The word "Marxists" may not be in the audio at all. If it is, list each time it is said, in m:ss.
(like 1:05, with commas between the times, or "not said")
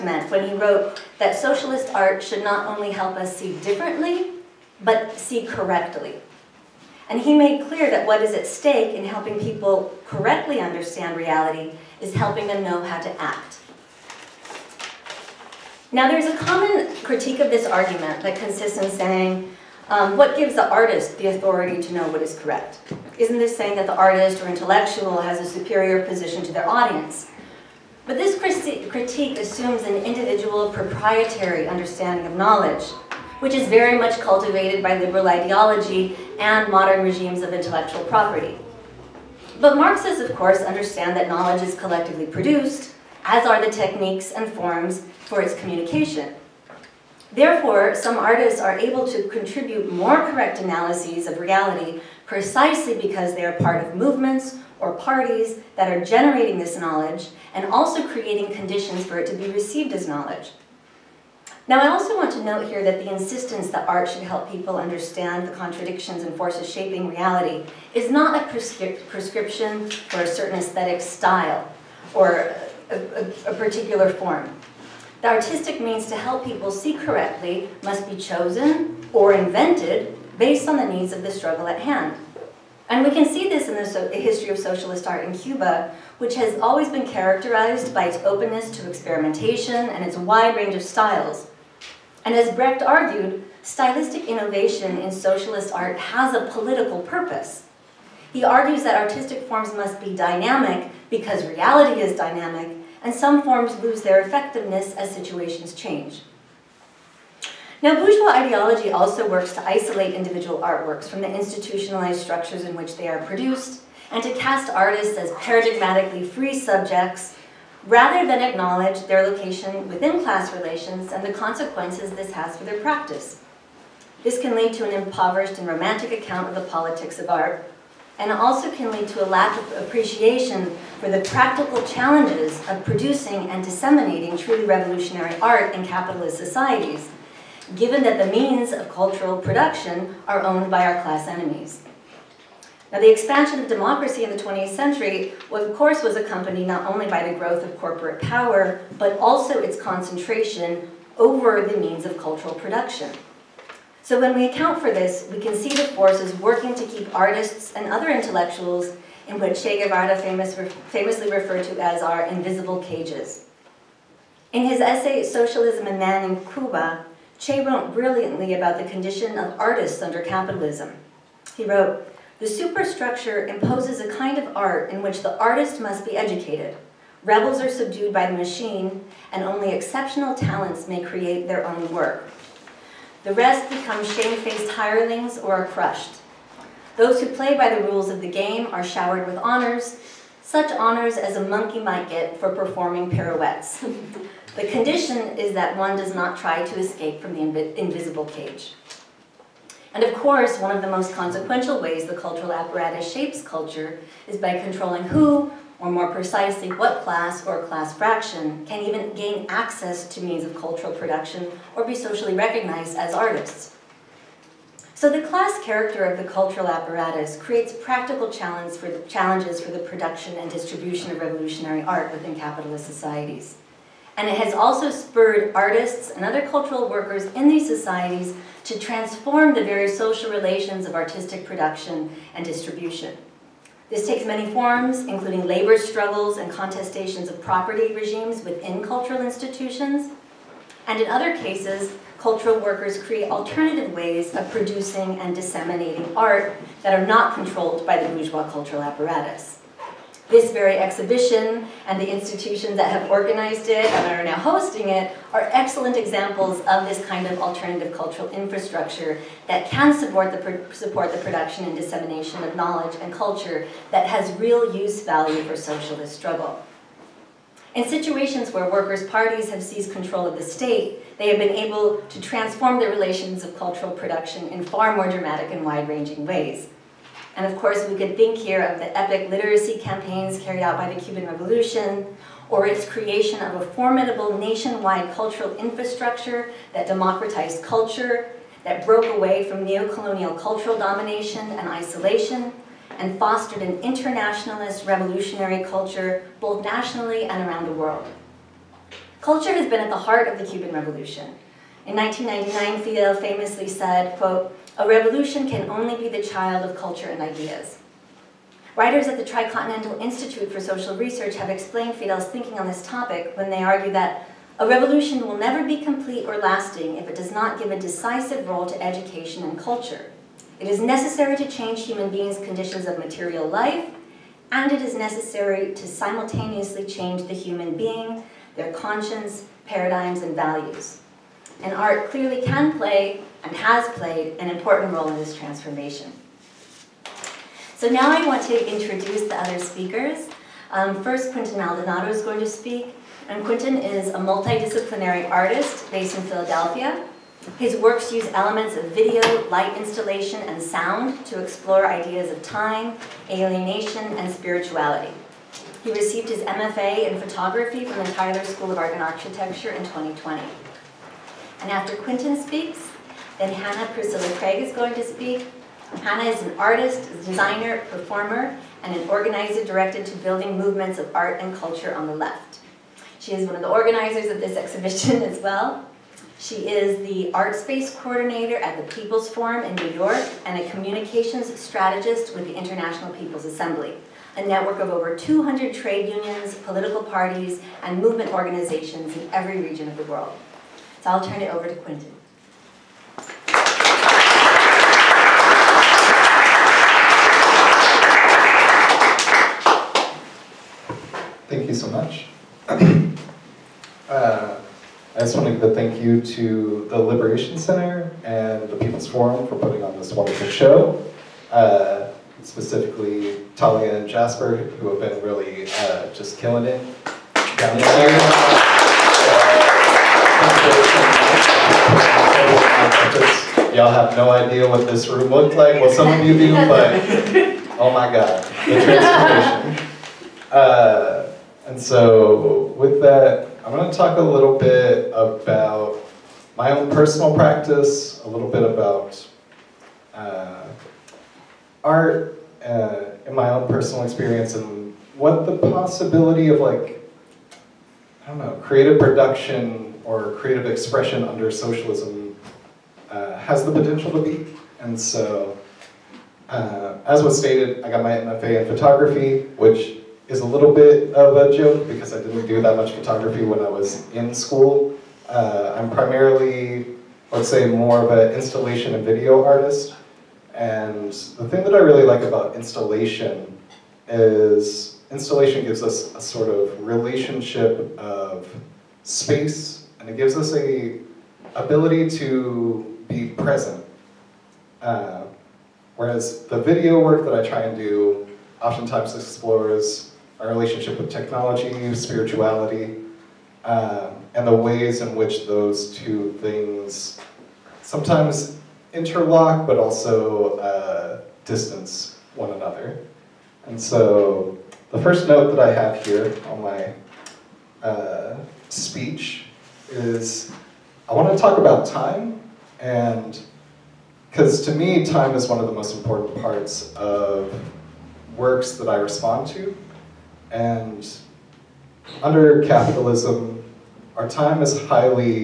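0:39.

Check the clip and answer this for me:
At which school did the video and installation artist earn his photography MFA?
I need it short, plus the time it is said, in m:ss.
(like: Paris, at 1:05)
Tyler School of Art and Architecture, at 5:58.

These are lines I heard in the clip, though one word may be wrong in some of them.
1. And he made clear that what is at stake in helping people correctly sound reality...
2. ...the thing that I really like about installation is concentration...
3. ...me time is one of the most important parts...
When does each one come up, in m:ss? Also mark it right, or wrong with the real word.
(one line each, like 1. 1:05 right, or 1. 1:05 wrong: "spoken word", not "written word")
1. 0:07 wrong: "understand", not "sound"
2. 7:51 wrong: "installation", not "concentration"
3. 8:34 right.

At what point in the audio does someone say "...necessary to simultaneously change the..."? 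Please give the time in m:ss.
5:24.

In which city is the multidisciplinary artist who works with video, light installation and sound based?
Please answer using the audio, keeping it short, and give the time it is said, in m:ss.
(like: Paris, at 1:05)
Philadelphia, at 5:46.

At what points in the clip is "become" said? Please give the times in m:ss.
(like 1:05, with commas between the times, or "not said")
3:03.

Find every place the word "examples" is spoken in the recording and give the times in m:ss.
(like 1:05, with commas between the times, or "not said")
4:15.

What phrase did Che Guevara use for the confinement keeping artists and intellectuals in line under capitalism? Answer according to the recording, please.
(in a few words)
invisible cages.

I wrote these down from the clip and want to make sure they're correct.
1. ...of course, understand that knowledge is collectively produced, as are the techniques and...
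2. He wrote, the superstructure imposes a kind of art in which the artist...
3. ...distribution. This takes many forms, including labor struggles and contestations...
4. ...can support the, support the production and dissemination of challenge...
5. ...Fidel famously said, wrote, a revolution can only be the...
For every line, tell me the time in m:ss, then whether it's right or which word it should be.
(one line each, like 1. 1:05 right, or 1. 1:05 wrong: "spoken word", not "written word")
1. 0:40 right
2. 2:51 right
3. 3:52 right
4. 4:19 wrong: "knowledge", not "challenge"
5. 5:02 wrong: "quote", not "wrote".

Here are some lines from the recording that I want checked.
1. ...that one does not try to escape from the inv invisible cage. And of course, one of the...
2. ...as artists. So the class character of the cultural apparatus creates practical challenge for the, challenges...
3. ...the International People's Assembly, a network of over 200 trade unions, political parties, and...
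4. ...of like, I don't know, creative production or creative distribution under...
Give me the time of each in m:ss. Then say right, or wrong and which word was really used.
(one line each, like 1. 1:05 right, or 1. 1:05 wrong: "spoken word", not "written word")
1. 3:15 right
2. 3:32 right
3. 6:22 right
4. 7:26 wrong: "expression", not "distribution".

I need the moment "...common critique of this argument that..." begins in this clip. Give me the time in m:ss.
0:16.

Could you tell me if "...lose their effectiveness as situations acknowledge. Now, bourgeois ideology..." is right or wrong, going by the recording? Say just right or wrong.
wrong.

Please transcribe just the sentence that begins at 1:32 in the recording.
And as Brecht argued, stylistic innovation in socialist art has a political purpose.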